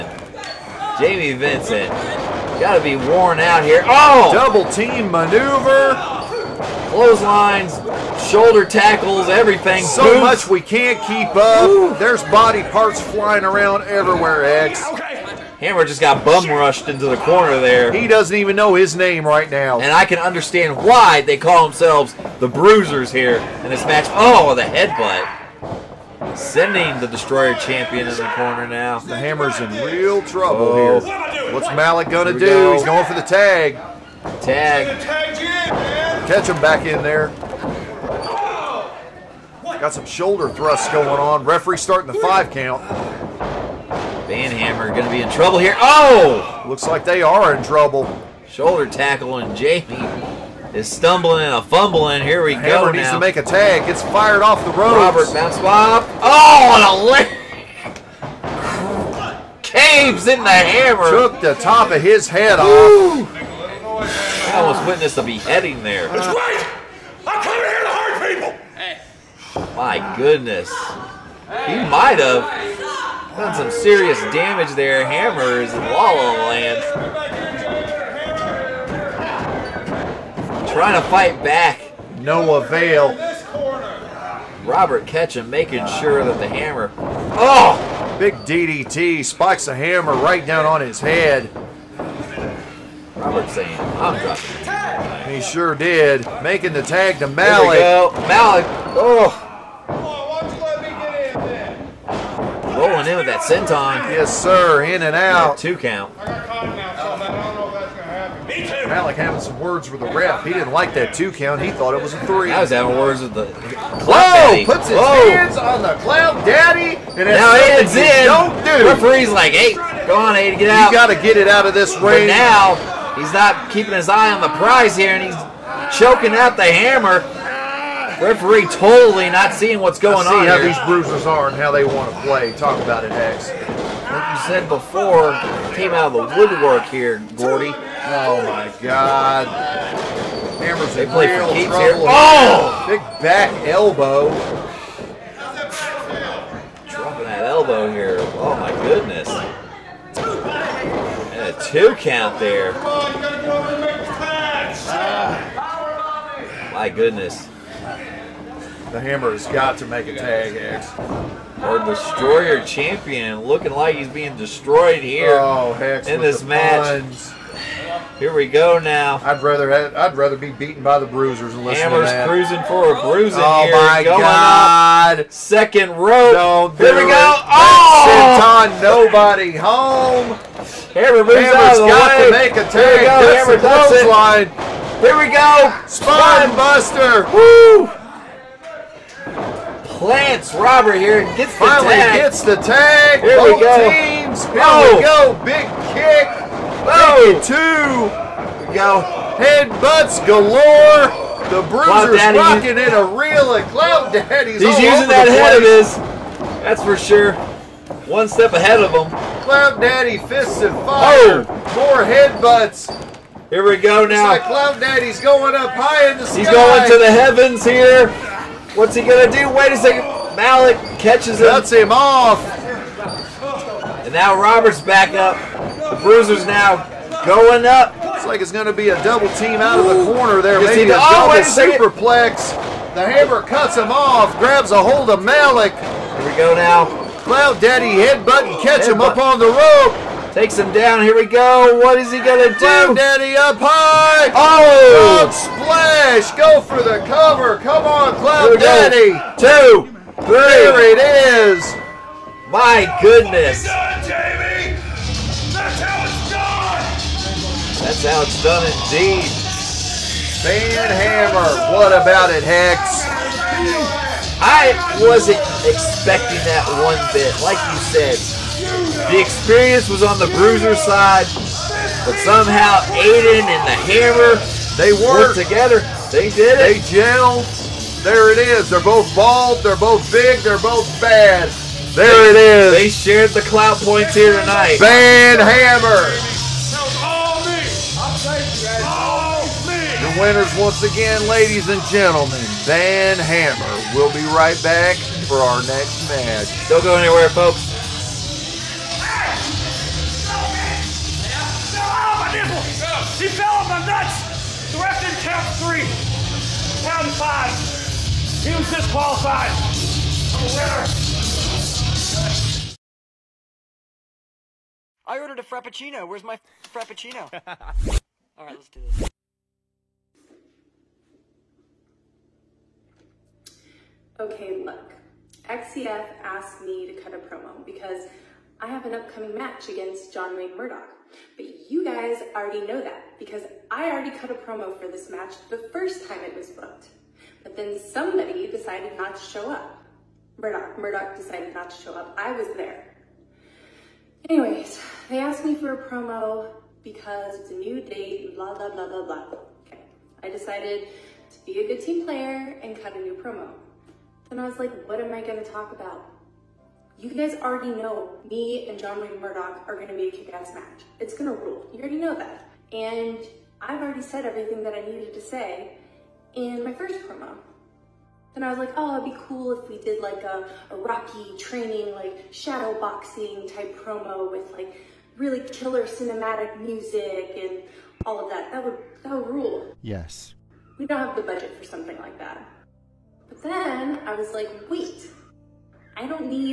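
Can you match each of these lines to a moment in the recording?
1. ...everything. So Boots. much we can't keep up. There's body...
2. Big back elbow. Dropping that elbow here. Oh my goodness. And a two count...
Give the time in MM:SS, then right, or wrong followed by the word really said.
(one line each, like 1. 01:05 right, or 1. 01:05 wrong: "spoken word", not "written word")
1. 00:09 right
2. 02:22 right.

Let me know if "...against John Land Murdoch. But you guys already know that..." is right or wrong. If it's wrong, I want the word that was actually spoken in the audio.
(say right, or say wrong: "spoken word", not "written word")
wrong: "Wayne", not "Land".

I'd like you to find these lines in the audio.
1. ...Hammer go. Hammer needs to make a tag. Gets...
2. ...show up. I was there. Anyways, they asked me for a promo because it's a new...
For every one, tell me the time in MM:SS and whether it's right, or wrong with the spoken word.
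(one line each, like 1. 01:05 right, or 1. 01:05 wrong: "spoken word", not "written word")
1. 00:52 right
2. 05:41 right.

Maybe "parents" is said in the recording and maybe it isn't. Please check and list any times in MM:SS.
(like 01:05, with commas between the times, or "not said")
not said.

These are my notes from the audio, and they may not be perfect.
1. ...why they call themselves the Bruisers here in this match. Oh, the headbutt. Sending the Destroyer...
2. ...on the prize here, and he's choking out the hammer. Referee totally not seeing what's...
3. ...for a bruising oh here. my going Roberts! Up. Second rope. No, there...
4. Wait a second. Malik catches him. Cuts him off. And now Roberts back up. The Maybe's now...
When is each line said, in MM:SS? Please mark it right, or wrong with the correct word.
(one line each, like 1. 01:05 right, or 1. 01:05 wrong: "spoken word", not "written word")
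1. 00:20 right
2. 02:04 right
3. 02:52 wrong: "God", not "Roberts"
4. 03:39 wrong: "Bruiser", not "Maybe".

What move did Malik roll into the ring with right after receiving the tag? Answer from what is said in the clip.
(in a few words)
Senton.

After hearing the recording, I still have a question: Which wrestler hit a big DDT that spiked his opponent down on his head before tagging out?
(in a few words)
Robert Ketchum.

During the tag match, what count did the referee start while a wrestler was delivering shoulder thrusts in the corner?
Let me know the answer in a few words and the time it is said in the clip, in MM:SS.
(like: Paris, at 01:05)
5, at 00:42.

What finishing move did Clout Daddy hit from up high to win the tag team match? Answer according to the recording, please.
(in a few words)
Cloud splash.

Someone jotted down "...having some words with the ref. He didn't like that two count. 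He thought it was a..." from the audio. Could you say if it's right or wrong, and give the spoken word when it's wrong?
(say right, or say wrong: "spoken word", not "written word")
right.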